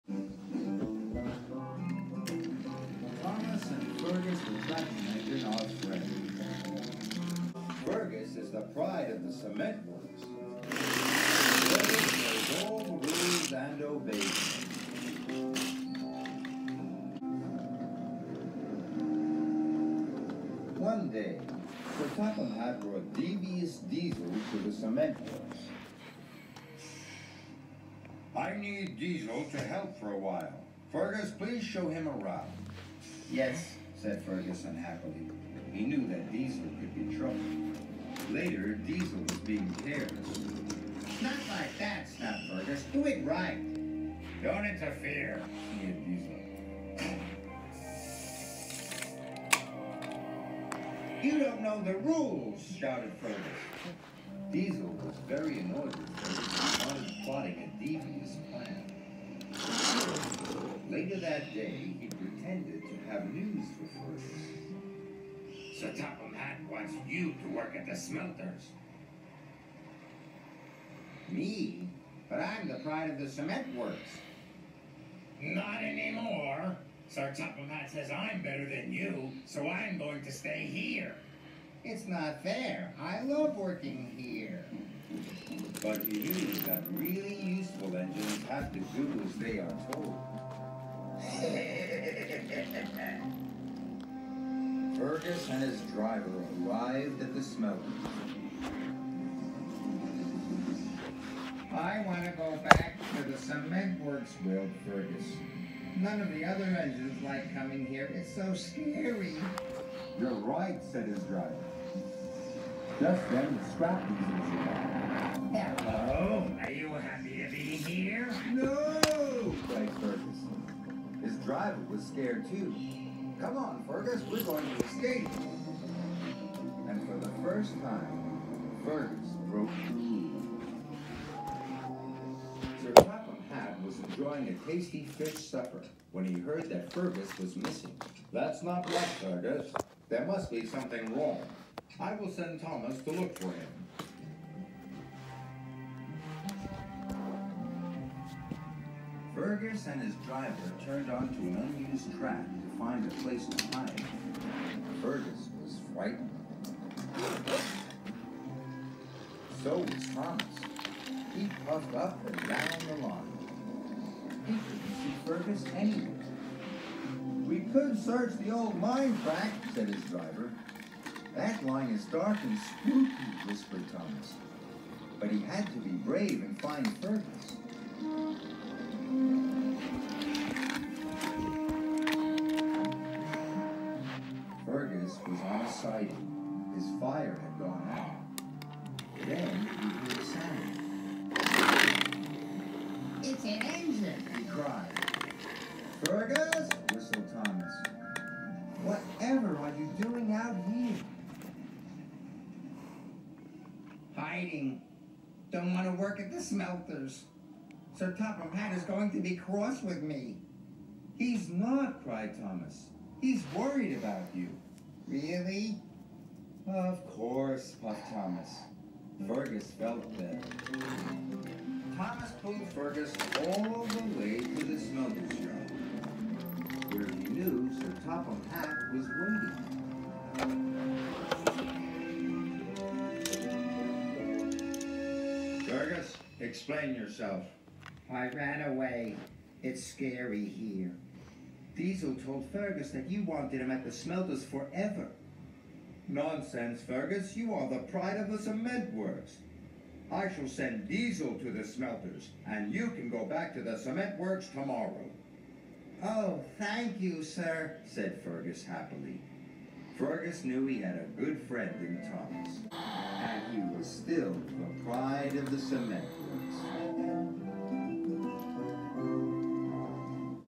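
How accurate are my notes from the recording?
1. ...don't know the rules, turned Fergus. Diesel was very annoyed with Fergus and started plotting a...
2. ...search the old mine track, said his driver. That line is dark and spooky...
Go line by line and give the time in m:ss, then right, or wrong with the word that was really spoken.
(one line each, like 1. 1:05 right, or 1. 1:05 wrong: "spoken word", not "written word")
1. 0:51 wrong: "shouted", not "turned"
2. 2:48 right.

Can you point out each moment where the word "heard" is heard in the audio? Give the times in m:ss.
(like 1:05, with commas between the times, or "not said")
2:16, 3:09.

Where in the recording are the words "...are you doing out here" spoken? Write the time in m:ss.
3:19.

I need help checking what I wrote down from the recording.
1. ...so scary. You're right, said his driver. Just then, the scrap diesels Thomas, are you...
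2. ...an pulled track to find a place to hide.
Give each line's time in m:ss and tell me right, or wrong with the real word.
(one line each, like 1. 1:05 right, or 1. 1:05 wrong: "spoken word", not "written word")
1. 1:48 wrong: "Hello", not "Thomas"
2. 2:31 wrong: "unused", not "pulled".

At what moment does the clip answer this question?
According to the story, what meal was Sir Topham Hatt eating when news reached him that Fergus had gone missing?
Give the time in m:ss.
2:15.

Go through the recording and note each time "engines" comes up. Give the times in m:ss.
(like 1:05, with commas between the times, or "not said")
1:27, 1:46, 3:13.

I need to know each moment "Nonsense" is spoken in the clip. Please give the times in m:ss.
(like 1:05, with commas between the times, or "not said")
4:06.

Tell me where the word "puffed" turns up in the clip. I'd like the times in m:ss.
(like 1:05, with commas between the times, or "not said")
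2:41, 3:37.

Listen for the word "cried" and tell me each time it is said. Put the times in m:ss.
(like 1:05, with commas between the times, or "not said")
3:14, 3:32.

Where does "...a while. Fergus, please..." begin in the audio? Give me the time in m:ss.
0:30.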